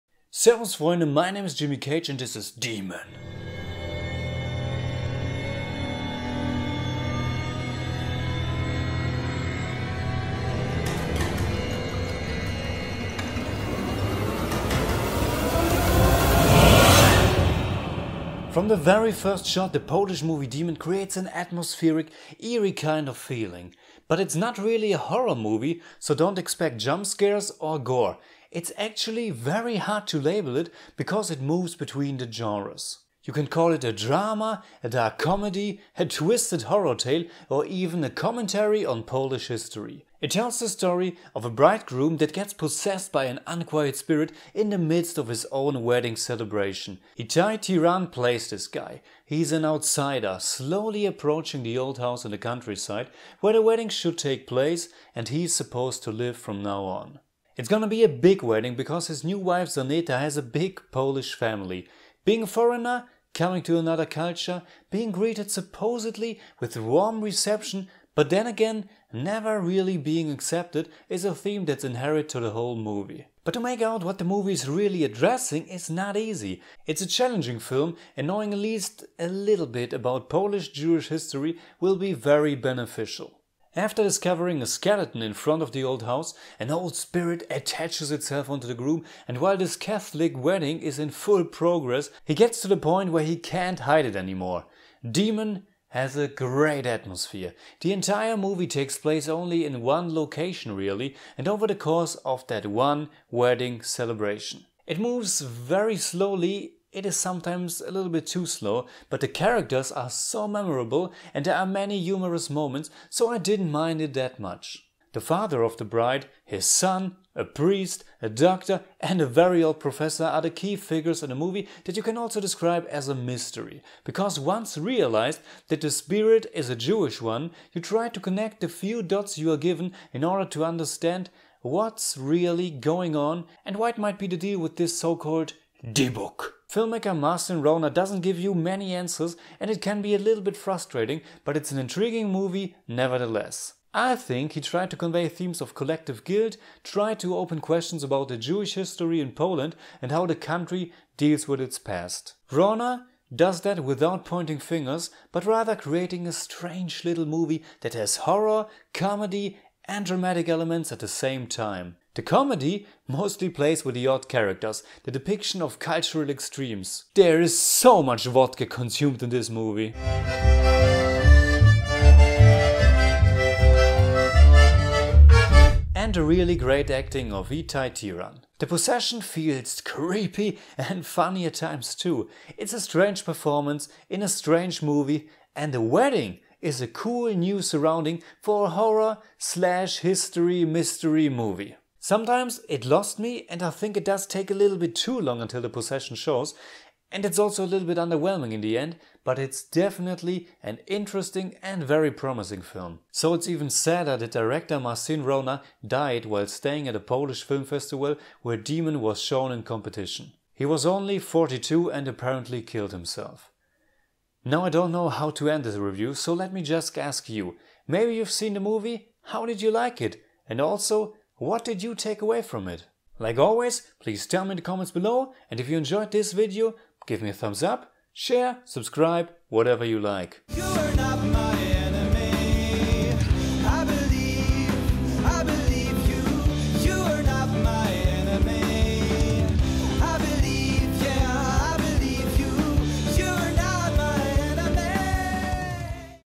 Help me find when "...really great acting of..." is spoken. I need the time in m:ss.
2:56.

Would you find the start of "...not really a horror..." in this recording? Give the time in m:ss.
0:24.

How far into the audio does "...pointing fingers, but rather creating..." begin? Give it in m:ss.
2:34.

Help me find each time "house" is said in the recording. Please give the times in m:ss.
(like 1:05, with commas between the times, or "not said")
0:51, 1:26.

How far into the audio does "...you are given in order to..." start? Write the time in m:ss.
2:09.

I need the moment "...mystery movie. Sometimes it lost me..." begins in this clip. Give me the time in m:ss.
3:10.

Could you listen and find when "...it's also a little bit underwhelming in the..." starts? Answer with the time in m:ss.
3:17.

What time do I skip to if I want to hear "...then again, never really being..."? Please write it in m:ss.
1:08.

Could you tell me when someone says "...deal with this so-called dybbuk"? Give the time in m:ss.
2:14.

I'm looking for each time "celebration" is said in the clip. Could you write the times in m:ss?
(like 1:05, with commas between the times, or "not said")
0:46, 1:43.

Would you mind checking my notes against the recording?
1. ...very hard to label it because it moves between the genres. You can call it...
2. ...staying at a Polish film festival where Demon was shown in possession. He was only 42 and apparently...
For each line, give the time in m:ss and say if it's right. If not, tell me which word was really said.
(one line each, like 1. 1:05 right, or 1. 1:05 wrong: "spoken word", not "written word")
1. 0:29 right
2. 3:26 wrong: "competition", not "possession".